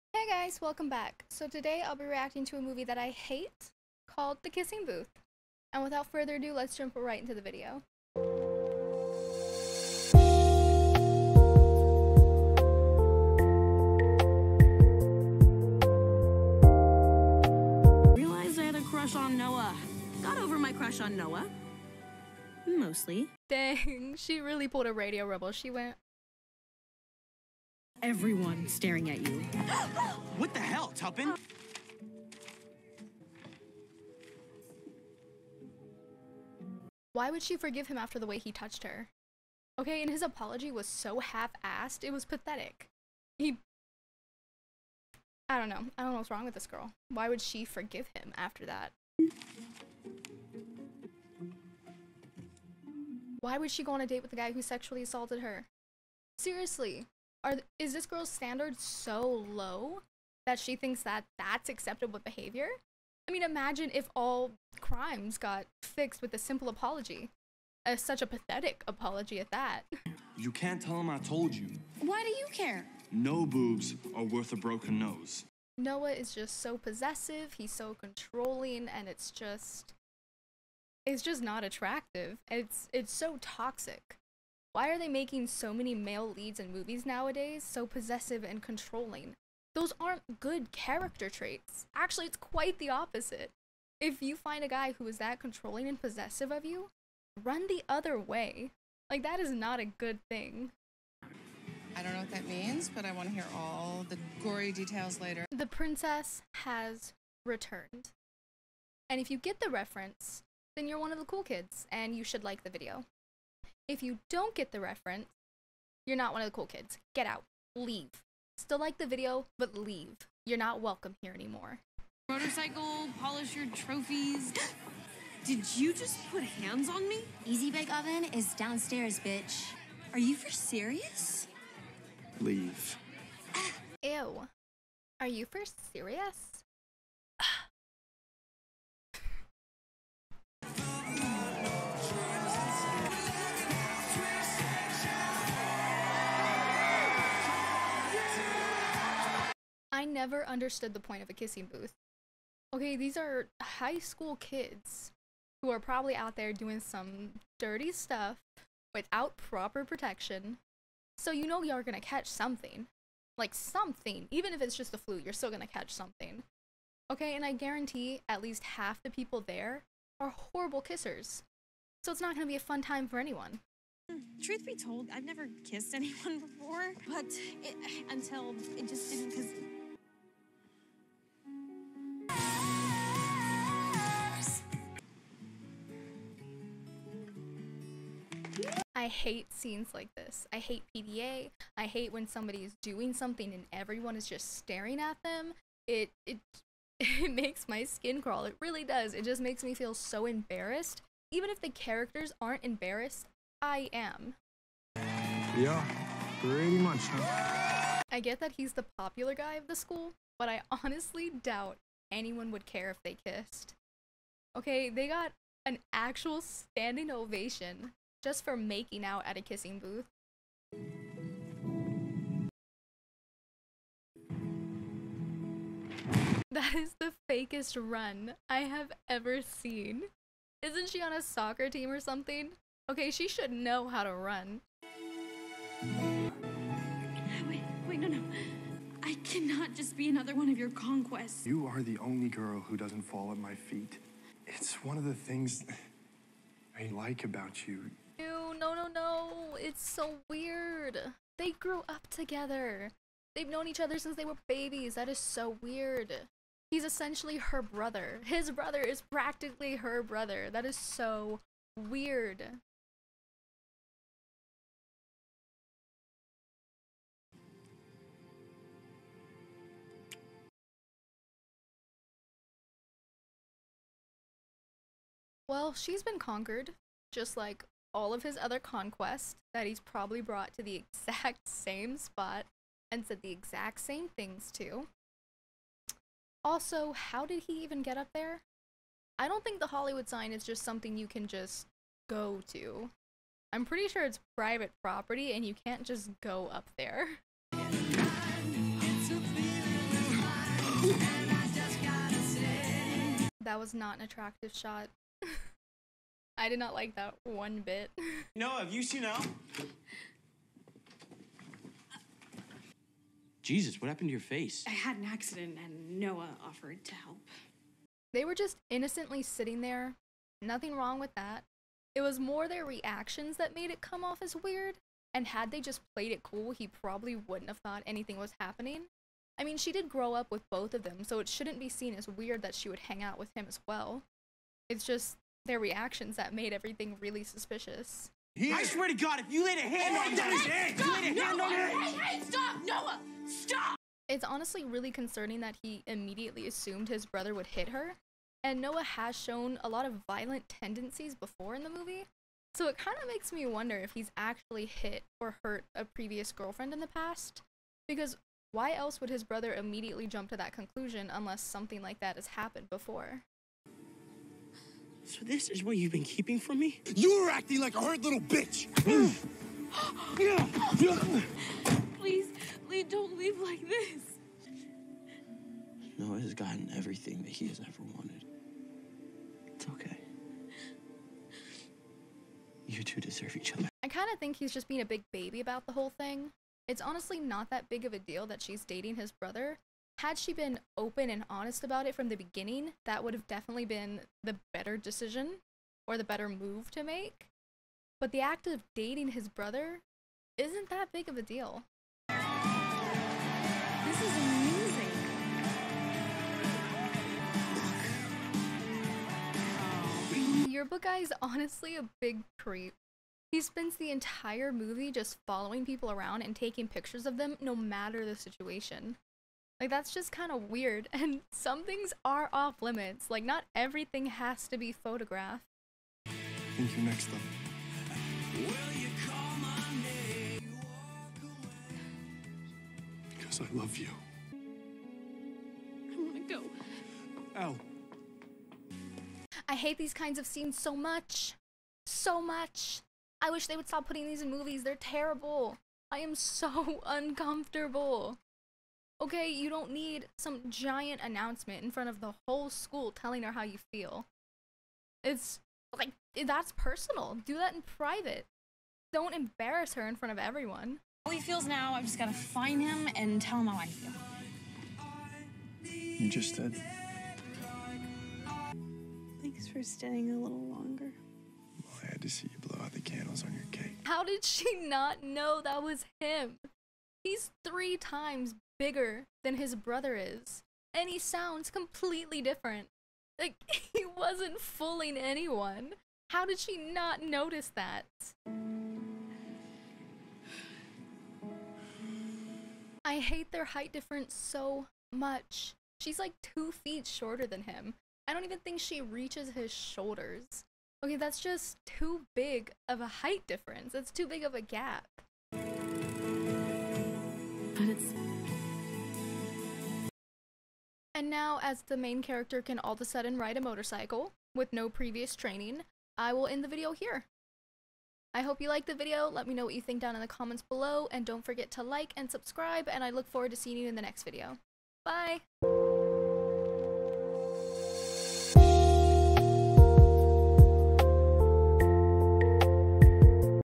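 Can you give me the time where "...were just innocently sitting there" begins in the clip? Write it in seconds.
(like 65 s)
318 s.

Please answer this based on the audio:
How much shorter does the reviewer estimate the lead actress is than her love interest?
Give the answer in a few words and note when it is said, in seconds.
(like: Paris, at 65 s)
2 feet, at 496 s.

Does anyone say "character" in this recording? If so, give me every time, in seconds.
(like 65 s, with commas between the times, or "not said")
90 s, 201 s, 512 s.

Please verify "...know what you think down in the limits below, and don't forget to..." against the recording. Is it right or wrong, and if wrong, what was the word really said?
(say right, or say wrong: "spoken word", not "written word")
wrong: "comments", not "limits".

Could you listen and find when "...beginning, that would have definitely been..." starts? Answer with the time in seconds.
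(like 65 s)
392 s.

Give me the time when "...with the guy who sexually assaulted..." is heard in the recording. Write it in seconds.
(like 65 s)
54 s.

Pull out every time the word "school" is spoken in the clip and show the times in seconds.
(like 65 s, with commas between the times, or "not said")
153 s, 209 s, 452 s.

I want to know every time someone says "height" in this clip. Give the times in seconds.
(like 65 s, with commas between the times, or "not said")
493 s, 502 s.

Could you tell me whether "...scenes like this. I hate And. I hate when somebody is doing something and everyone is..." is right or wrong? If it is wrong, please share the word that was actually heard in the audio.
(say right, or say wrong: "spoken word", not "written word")
wrong: "PDA", not "And".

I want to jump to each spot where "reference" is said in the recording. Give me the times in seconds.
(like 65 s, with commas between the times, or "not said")
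109 s, 114 s.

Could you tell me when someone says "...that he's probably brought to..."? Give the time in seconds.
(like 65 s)
279 s.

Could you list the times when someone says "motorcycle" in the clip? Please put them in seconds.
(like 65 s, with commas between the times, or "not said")
122 s, 513 s.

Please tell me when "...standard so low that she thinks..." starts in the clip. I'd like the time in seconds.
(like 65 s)
58 s.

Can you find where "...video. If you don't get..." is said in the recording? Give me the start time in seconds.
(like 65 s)
112 s.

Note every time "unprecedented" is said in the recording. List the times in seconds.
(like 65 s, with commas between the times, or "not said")
not said.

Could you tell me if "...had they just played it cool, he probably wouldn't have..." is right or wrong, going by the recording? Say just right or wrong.
right.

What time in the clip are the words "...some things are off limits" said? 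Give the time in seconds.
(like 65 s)
421 s.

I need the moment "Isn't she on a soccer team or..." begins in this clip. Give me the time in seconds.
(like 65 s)
230 s.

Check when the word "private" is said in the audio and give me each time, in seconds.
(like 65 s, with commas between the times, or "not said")
294 s, 457 s.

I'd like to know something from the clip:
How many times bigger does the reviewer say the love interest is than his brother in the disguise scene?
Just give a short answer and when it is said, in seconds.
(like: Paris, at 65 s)
3, at 477 s.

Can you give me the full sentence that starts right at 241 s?
You are the only girl who doesn't fall at my feet.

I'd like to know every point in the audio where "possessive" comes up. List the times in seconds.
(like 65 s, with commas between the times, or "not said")
76 s, 87 s, 96 s.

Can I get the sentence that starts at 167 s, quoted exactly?
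Okay, and I guarantee at least half the people there are horrible kissers.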